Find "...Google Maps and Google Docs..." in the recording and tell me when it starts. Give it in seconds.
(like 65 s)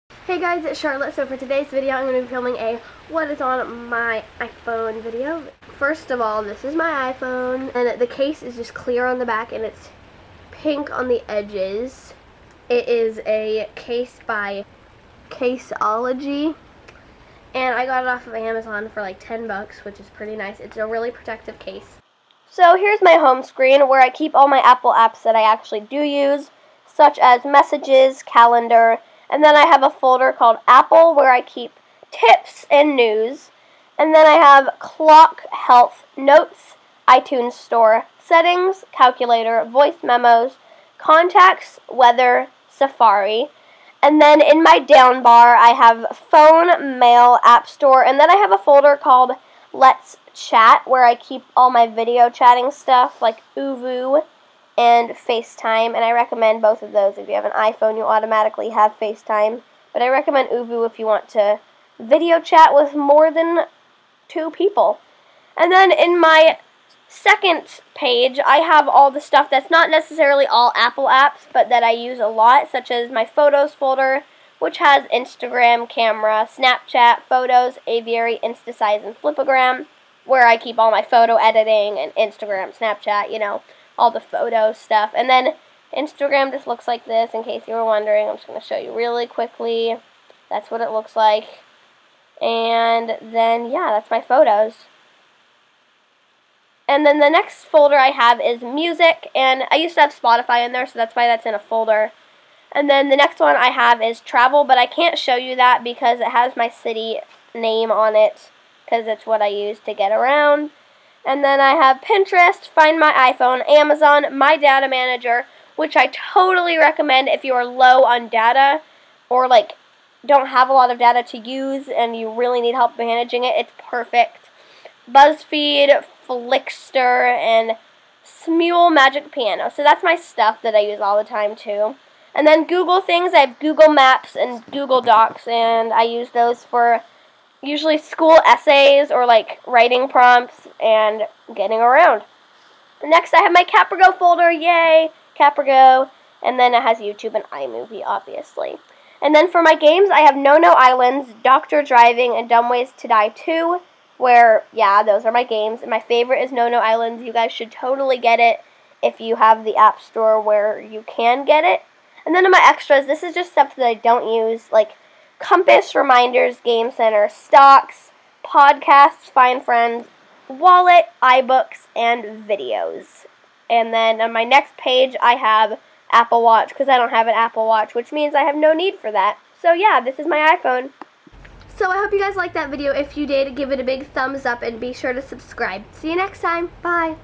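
133 s.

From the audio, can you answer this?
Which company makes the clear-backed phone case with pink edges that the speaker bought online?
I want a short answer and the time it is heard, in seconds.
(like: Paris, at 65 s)
Caseology, at 15 s.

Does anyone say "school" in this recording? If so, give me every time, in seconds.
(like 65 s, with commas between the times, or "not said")
137 s.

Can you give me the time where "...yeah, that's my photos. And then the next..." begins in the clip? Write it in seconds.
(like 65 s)
93 s.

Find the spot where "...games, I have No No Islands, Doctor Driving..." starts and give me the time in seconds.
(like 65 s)
149 s.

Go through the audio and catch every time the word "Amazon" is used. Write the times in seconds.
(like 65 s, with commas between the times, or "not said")
18 s, 113 s.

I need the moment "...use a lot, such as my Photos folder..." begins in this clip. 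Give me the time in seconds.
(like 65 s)
71 s.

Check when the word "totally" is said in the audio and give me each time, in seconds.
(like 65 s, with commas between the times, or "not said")
116 s, 157 s.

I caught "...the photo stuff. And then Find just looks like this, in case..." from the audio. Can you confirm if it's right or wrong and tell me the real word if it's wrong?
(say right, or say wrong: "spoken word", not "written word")
wrong: "Instagram", not "Find".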